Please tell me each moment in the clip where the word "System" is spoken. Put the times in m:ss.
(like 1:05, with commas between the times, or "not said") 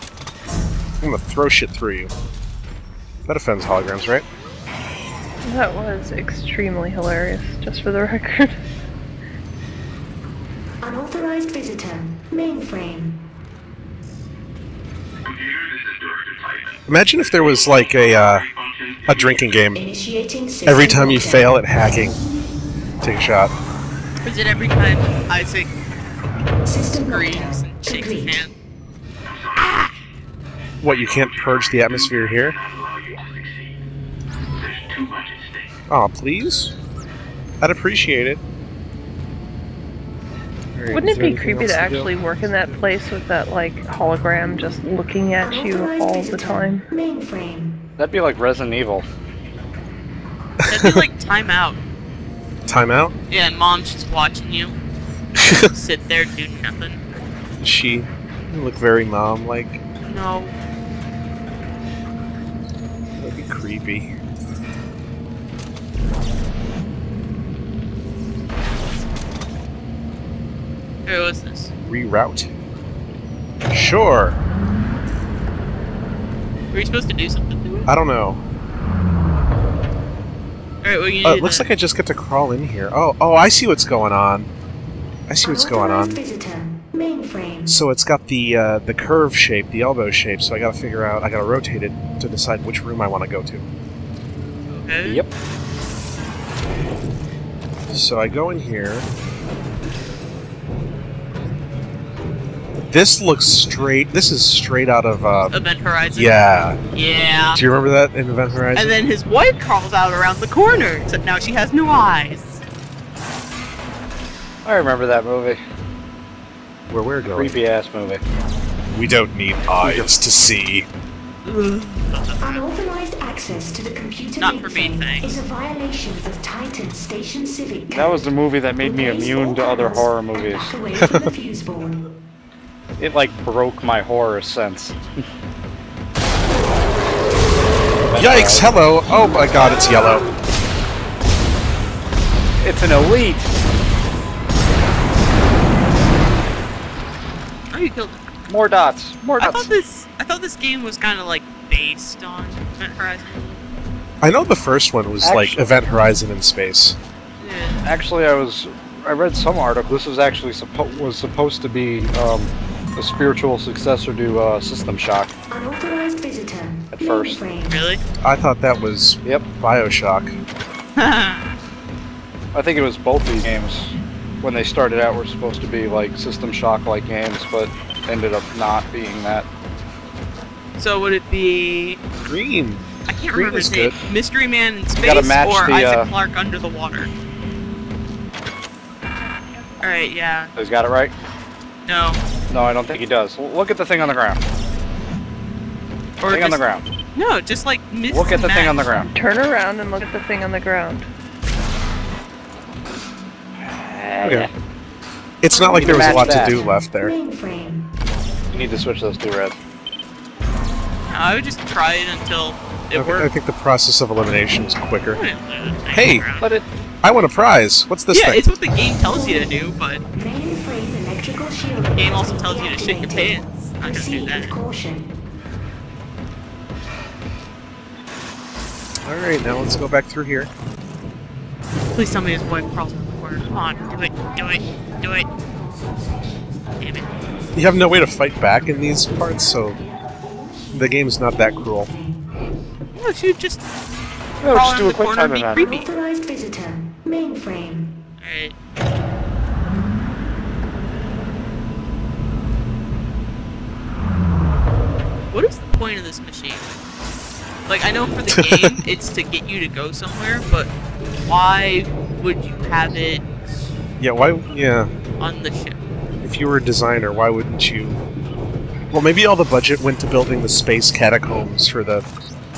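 2:44, 2:56.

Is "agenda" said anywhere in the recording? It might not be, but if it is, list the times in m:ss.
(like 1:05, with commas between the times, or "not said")
not said.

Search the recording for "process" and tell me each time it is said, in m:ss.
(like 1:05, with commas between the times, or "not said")
3:33.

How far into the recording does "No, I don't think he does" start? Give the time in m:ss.
3:12.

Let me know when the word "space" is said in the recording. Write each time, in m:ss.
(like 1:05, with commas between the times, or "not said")
2:36, 3:04, 4:30.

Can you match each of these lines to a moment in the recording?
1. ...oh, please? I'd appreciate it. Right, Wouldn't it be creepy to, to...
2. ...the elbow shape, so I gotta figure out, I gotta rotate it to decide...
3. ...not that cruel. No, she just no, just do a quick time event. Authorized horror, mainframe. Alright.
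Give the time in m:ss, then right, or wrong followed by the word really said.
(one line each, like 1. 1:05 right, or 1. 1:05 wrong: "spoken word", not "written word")
1. 0:35 right
2. 1:29 right
3. 4:01 wrong: "visitor", not "horror".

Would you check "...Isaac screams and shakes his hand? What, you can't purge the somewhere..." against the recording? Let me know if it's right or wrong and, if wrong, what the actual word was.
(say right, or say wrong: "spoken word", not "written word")
wrong: "atmosphere", not "somewhere".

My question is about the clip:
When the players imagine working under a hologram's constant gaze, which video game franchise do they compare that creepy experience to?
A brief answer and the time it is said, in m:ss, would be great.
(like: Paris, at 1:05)
Resident Evil, at 0:48.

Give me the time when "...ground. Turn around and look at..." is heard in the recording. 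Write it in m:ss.
3:18.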